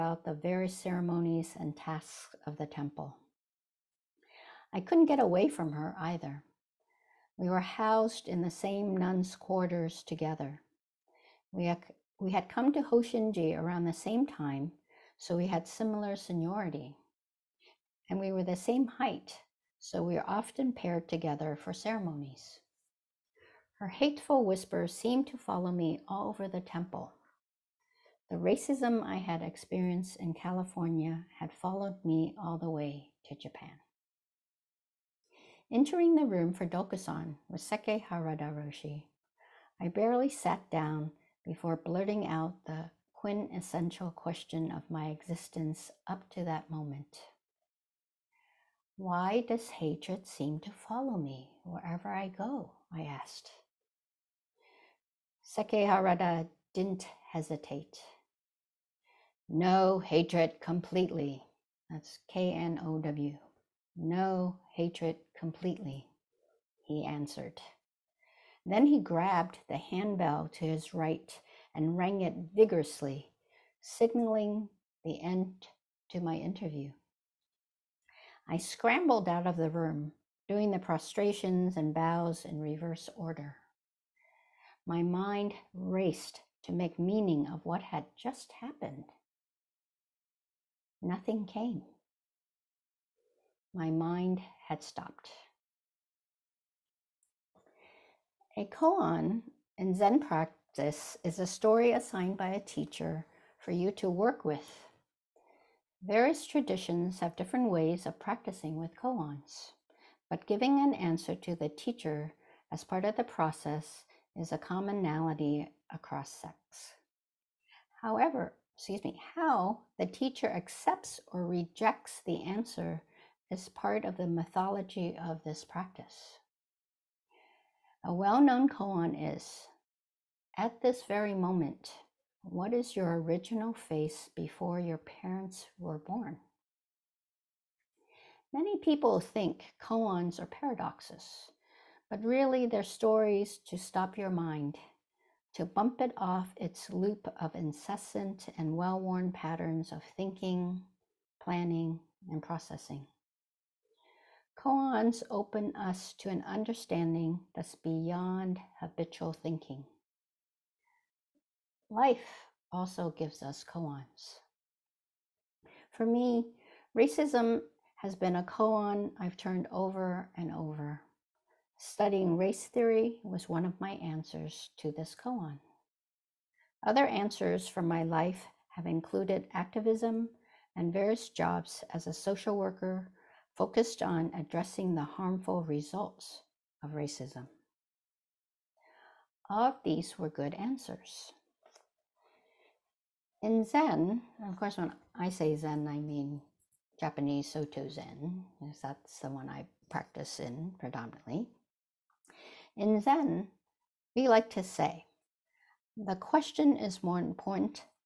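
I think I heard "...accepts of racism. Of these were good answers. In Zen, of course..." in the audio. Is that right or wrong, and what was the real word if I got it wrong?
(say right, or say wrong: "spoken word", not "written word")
wrong: "results", not "accepts".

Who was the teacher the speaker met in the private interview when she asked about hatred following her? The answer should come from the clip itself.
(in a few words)
Sekkei Harada Roshi.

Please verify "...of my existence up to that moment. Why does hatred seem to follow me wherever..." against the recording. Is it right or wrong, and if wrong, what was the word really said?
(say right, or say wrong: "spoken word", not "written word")
right.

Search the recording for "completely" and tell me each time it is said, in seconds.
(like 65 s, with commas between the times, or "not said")
60 s, 65 s.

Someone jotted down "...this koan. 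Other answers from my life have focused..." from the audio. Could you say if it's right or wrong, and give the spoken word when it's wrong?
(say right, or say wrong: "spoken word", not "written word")
wrong: "included", not "focused".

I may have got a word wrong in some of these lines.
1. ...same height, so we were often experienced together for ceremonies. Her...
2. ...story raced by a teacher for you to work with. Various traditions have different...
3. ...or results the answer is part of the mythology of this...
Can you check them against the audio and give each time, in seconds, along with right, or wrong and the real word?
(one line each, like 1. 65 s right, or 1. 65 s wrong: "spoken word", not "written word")
1. 18 s wrong: "paired", not "experienced"
2. 101 s wrong: "assigned", not "raced"
3. 121 s wrong: "rejects", not "results".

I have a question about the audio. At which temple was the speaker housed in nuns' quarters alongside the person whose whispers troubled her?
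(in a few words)
Hosshinji.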